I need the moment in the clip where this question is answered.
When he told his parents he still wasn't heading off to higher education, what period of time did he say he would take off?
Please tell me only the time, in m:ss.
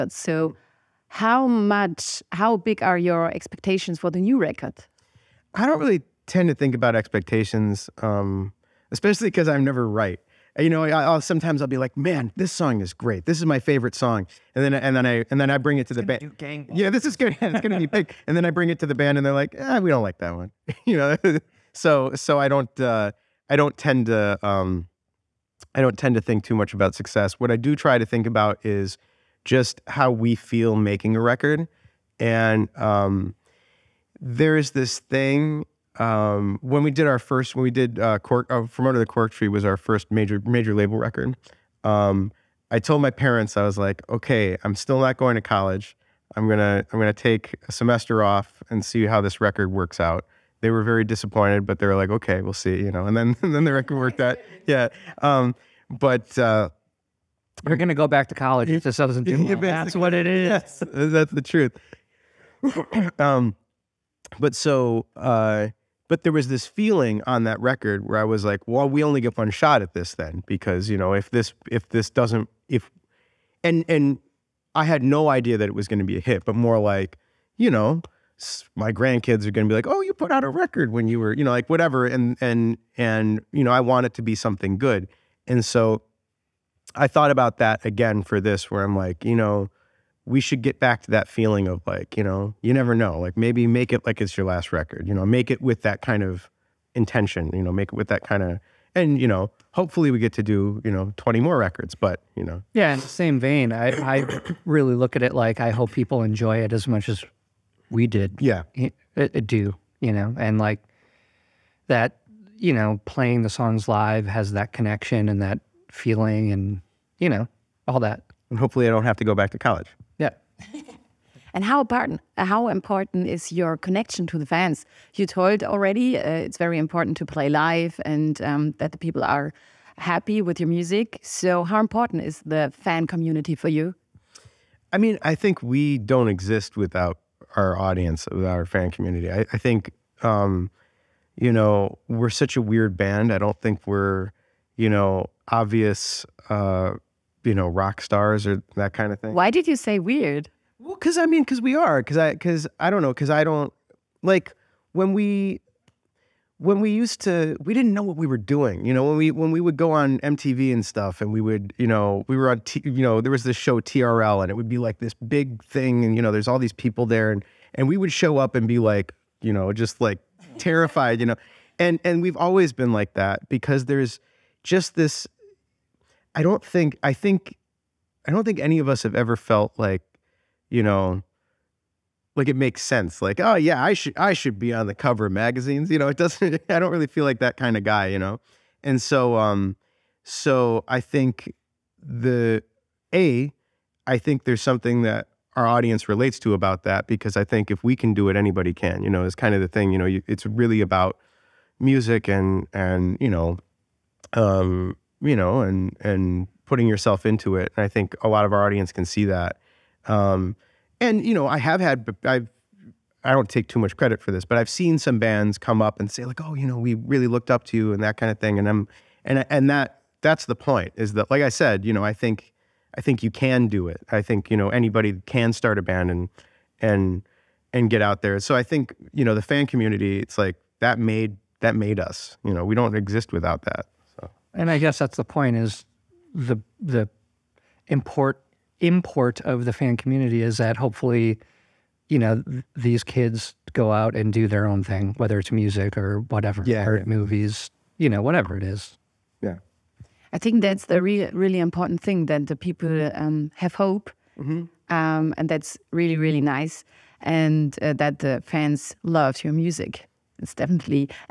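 0:47.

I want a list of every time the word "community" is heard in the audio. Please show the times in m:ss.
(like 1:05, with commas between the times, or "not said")
2:13, 2:18, 3:49, 3:59.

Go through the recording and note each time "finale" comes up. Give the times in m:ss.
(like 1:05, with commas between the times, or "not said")
not said.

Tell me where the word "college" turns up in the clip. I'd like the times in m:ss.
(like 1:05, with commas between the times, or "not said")
0:45, 0:58, 1:59.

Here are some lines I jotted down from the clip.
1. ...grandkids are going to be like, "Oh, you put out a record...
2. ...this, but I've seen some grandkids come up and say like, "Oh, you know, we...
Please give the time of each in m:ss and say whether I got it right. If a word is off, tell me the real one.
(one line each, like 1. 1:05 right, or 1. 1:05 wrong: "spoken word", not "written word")
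1. 1:18 right
2. 3:34 wrong: "bands", not "grandkids".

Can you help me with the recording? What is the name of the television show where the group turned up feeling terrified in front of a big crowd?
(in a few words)
TRL.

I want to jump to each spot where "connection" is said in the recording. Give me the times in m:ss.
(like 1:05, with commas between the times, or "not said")
1:54, 2:03.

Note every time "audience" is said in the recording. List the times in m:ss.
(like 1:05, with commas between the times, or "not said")
2:17, 3:15, 3:28.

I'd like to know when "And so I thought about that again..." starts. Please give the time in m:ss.
1:25.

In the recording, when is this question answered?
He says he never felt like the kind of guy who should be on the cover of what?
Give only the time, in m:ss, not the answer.
3:05.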